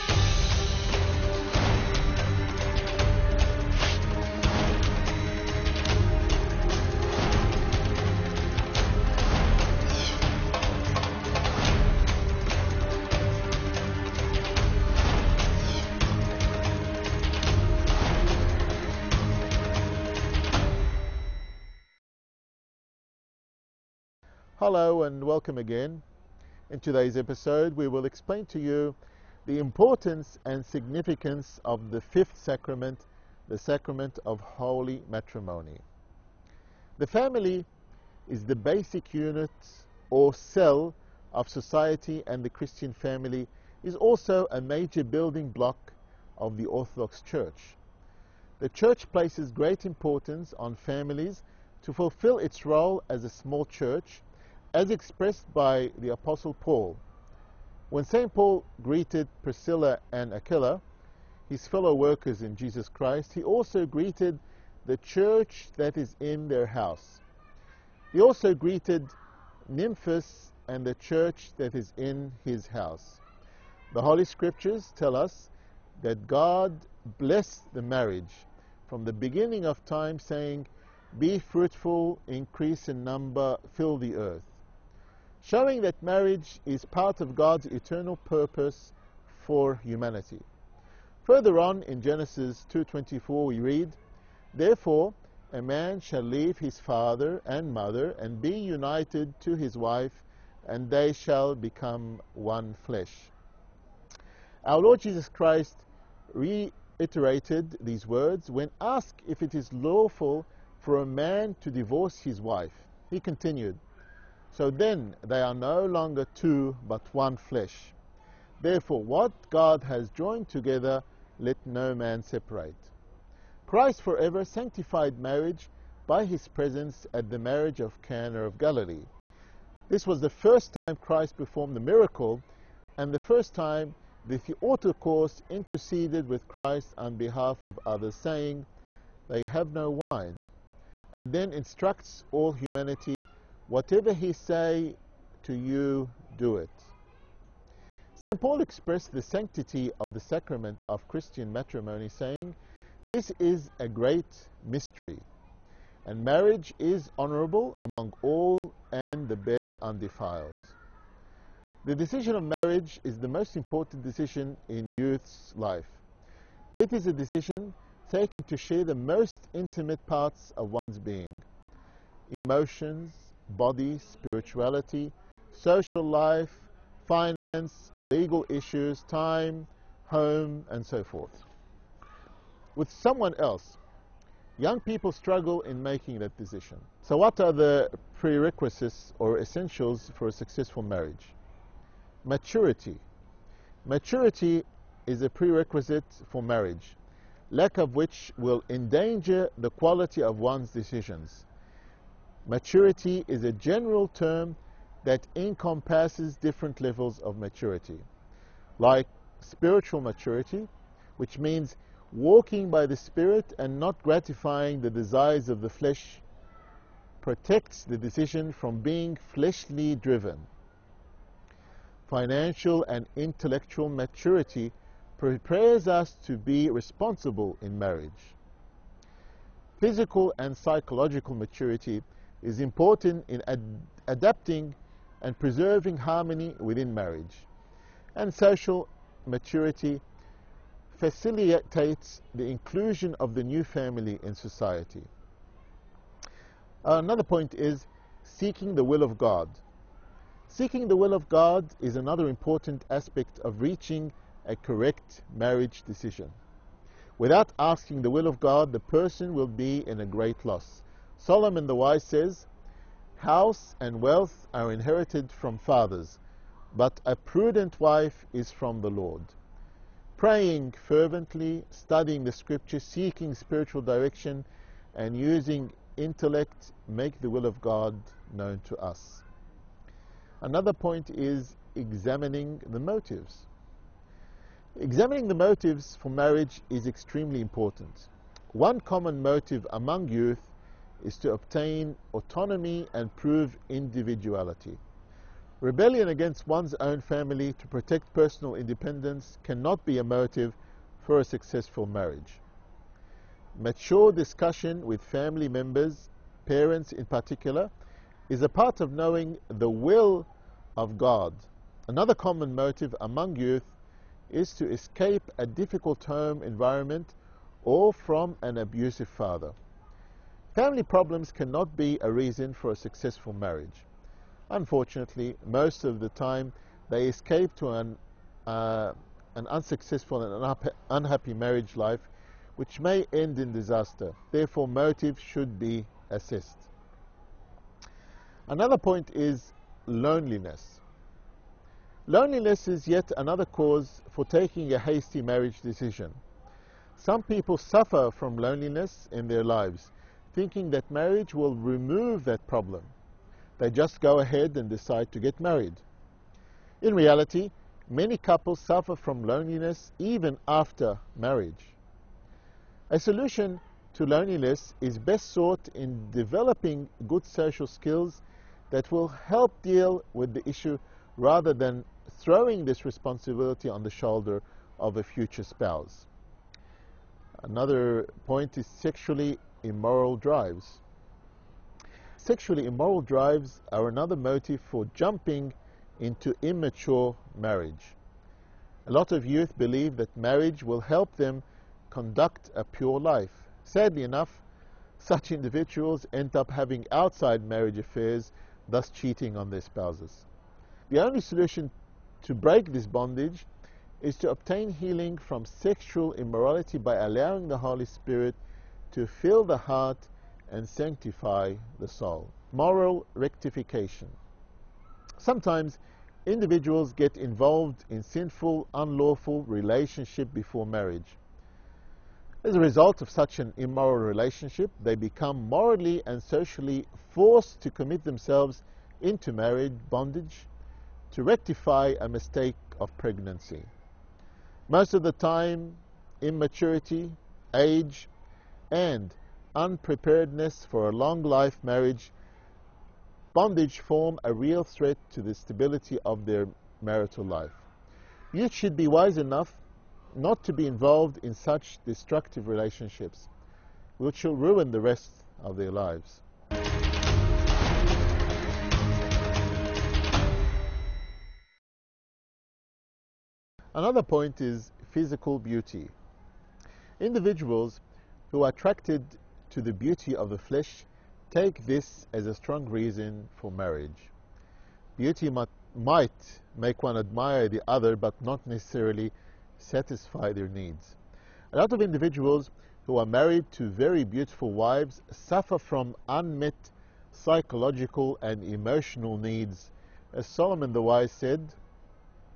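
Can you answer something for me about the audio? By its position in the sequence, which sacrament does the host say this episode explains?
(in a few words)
fifth.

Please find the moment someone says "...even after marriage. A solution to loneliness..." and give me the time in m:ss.
5:59.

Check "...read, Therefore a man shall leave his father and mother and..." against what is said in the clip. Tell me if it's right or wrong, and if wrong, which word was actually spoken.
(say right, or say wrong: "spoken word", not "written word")
right.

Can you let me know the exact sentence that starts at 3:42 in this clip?
Financial and intellectual maturity prepares us to be responsible in marriage.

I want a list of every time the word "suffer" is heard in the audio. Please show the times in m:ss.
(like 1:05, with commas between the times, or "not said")
5:47, 5:58, 8:05.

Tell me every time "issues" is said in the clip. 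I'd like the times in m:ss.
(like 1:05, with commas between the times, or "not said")
2:58, 6:10.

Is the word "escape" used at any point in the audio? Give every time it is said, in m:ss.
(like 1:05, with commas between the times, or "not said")
5:14, 5:27.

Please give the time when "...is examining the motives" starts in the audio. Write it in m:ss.
4:41.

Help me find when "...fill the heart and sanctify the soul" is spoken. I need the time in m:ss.
6:49.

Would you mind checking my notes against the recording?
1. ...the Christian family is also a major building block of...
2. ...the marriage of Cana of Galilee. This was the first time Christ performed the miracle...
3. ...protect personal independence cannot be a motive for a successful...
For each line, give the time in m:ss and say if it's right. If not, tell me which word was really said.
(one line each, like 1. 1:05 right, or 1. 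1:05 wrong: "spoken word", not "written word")
1. 0:42 right
2. 2:07 right
3. 4:57 right.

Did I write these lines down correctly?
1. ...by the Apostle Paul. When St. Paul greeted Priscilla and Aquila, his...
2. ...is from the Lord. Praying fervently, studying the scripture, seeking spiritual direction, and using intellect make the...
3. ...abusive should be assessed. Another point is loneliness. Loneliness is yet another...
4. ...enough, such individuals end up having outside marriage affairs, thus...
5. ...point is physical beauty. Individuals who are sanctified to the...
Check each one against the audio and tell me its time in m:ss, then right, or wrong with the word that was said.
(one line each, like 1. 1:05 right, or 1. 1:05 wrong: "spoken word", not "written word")
1. 0:55 right
2. 4:28 right
3. 5:34 wrong: "motive", not "abusive"
4. 6:34 right
5. 7:44 wrong: "attracted", not "sanctified".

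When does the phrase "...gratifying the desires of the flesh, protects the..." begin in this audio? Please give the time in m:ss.
3:34.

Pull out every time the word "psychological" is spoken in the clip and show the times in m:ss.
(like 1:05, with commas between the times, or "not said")
3:50, 8:07.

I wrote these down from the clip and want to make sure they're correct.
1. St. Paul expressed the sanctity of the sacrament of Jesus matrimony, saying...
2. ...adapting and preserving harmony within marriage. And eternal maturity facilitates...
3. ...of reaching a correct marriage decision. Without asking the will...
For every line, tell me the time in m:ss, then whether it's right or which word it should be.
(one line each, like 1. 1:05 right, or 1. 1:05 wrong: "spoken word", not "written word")
1. 2:28 wrong: "Christian", not "Jesus"
2. 3:54 wrong: "social", not "eternal"
3. 4:13 right.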